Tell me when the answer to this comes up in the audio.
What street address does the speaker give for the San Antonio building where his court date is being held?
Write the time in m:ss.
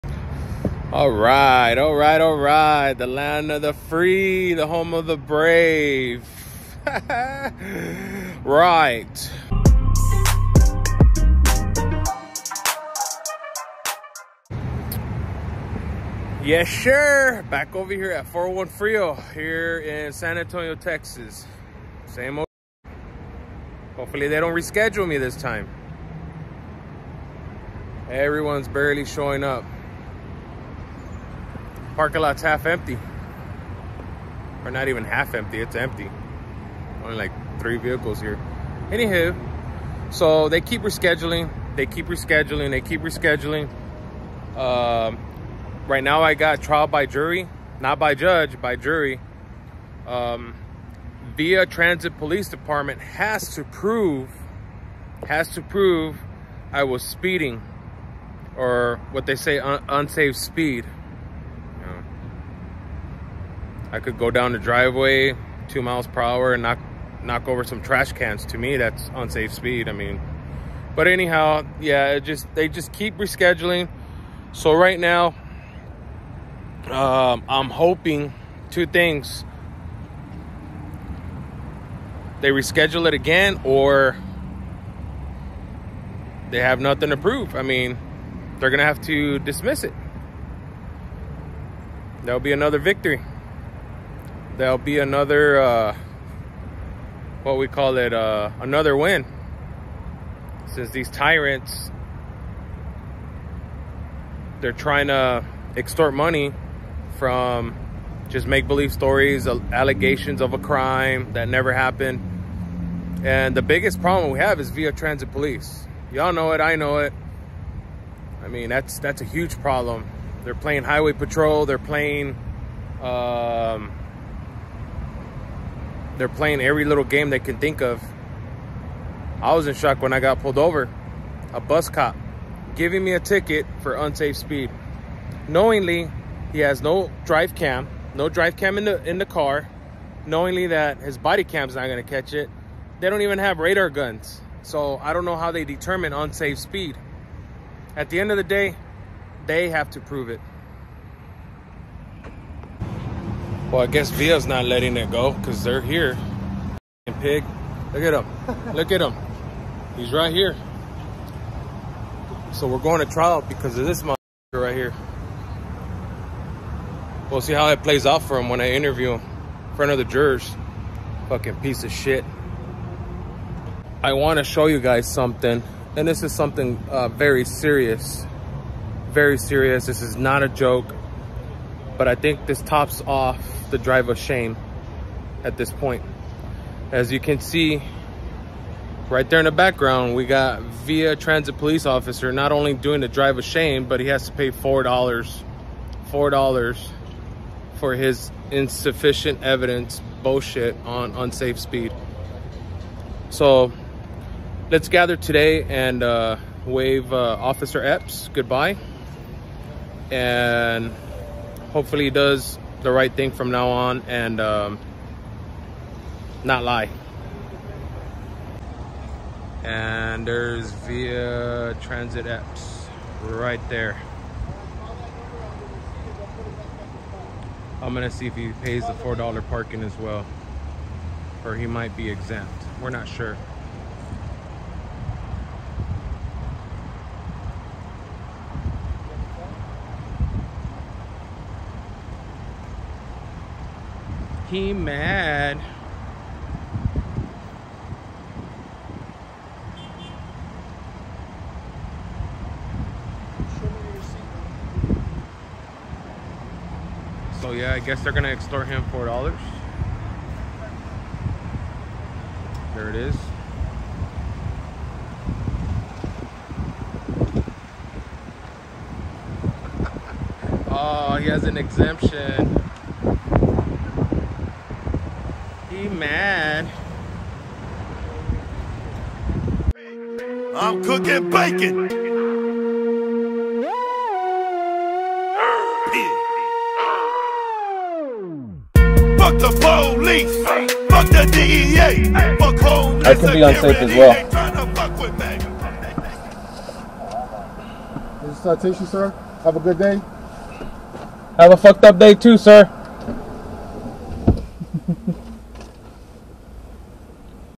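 0:18.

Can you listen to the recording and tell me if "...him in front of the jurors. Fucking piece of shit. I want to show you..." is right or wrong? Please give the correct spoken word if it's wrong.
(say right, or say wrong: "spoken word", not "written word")
right.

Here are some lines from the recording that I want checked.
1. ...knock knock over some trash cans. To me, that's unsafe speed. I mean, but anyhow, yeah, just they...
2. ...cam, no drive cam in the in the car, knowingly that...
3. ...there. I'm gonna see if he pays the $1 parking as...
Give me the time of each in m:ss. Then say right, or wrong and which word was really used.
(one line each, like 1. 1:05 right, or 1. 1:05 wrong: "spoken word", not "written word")
1. 1:06 right
2. 2:17 right
3. 3:43 wrong: "4", not "1".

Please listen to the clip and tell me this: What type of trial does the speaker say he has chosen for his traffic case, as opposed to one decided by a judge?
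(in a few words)
trial by jury.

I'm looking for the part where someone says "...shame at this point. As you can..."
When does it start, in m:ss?
3:04.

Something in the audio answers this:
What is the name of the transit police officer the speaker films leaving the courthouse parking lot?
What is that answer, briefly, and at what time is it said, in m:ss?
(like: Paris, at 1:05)
Officer Epps, at 3:27.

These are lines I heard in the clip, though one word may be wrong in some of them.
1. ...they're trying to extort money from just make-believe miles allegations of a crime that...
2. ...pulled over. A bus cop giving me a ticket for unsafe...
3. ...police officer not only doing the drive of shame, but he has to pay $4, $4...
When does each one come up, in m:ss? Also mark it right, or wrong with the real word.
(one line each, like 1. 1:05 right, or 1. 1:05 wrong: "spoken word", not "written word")
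1. 1:44 wrong: "stories", not "miles"
2. 2:10 right
3. 3:11 right.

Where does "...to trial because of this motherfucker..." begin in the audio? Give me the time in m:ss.
2:42.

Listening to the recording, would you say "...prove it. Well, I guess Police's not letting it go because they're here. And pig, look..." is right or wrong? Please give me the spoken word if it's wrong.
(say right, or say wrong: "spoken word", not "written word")
wrong: "Via", not "Police".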